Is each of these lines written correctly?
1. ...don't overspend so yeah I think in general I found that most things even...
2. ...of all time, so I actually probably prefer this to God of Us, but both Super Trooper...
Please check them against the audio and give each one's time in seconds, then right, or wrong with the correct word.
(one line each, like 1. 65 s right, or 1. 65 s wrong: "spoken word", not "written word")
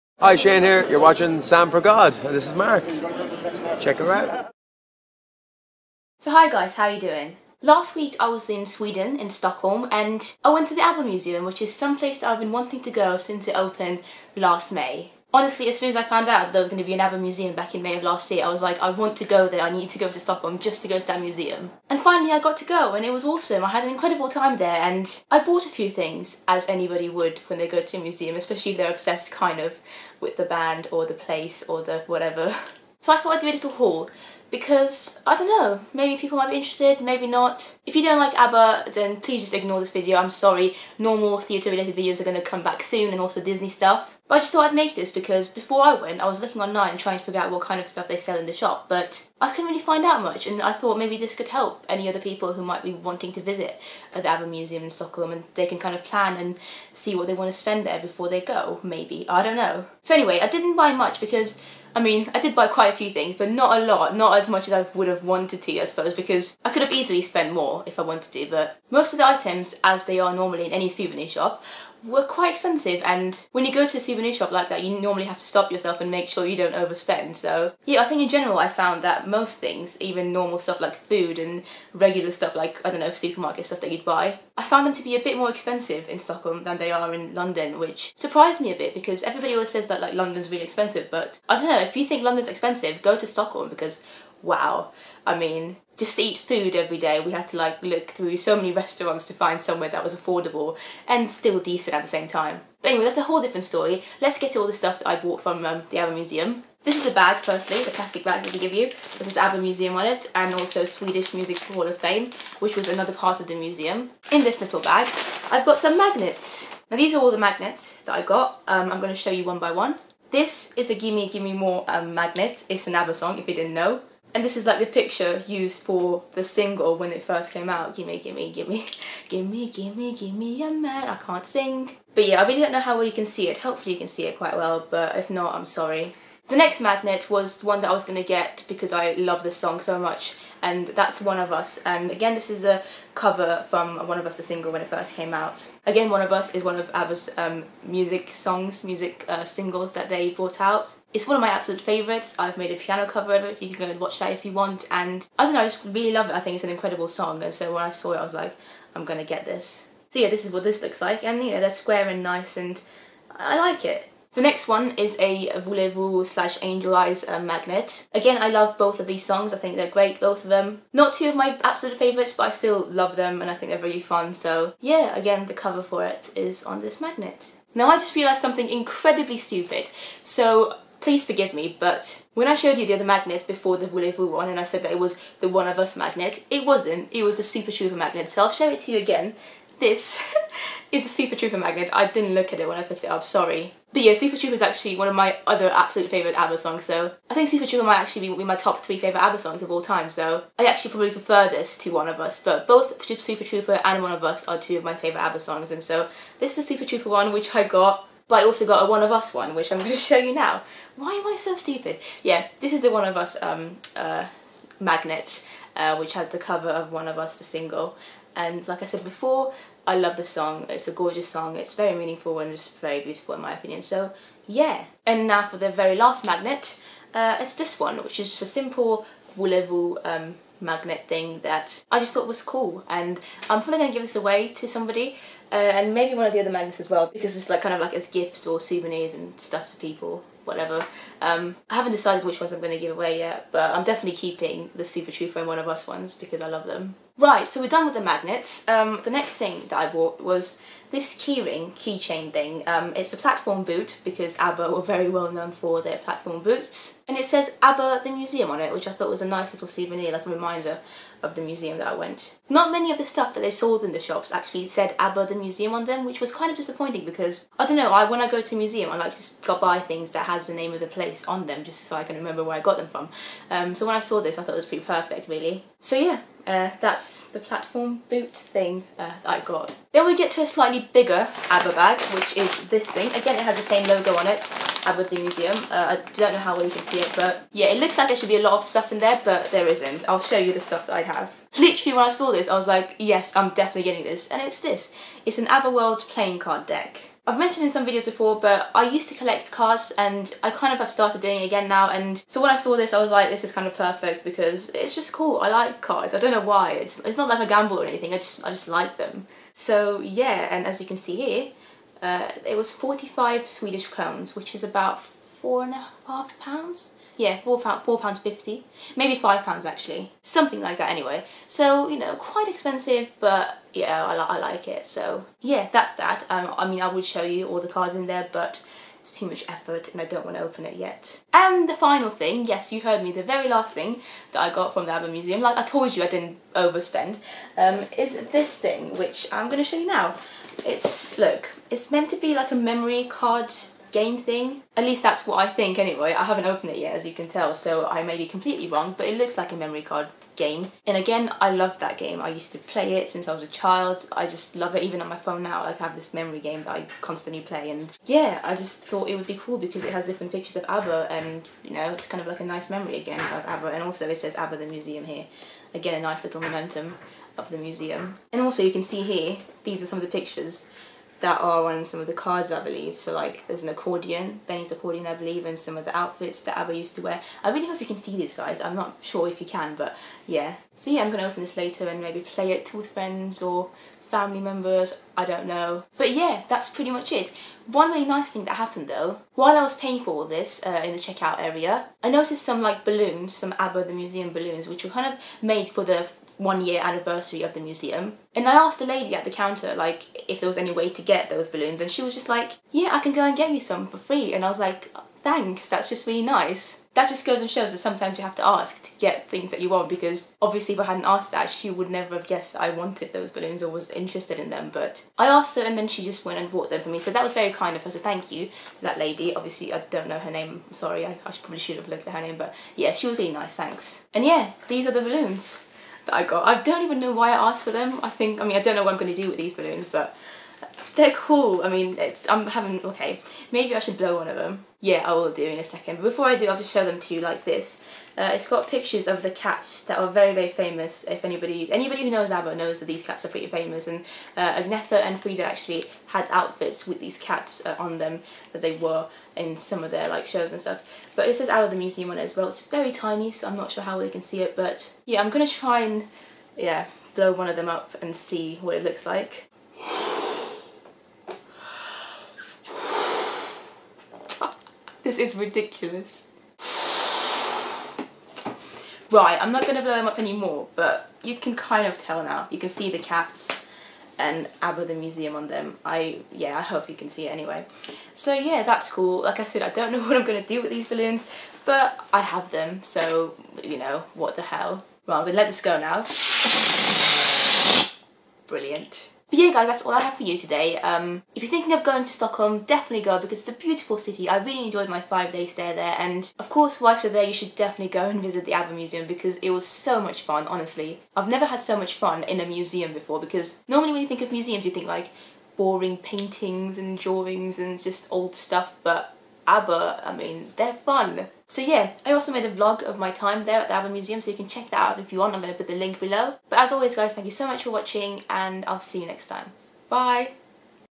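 1. 76 s right
2. 199 s wrong: "One", not "God".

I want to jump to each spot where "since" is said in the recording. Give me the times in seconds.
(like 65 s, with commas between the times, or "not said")
13 s, 353 s.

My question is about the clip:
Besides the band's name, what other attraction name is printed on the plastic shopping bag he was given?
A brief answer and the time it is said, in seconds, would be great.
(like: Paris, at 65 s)
Swedish Music Hall of Fame, at 110 s.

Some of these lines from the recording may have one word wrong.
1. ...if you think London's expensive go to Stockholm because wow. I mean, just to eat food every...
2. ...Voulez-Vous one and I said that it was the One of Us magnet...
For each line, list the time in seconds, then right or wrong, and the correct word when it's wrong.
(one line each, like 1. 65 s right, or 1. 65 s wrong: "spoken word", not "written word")
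1. 91 s right
2. 183 s right.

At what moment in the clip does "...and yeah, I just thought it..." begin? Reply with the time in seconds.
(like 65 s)
357 s.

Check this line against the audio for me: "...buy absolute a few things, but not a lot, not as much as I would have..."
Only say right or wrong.
wrong.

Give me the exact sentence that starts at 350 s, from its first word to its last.
And again, I love that game.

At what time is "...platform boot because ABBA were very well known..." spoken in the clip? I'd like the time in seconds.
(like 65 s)
253 s.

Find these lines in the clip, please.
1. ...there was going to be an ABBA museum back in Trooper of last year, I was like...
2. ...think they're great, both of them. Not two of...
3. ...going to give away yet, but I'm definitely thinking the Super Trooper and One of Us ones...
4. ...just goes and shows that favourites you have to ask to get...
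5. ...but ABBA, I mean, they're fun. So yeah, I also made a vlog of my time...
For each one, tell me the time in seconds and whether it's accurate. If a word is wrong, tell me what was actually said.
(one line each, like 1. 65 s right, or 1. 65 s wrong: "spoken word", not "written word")
1. 16 s wrong: "May", not "Trooper"
2. 169 s right
3. 242 s wrong: "keeping", not "thinking"
4. 407 s wrong: "sometimes", not "favourites"
5. 508 s right.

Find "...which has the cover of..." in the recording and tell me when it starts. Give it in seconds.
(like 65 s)
215 s.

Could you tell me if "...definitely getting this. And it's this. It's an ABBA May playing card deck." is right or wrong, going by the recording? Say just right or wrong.
wrong.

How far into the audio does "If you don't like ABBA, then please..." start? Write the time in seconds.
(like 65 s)
37 s.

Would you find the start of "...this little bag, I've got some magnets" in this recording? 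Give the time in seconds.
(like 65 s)
114 s.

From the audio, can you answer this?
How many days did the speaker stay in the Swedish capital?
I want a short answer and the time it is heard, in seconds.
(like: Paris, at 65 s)
5, at 494 s.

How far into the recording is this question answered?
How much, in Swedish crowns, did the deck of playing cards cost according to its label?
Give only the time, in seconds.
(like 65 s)
312 s.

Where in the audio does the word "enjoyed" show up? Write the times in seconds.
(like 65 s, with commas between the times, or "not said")
494 s.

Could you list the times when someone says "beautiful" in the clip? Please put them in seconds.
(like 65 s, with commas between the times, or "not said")
223 s, 493 s.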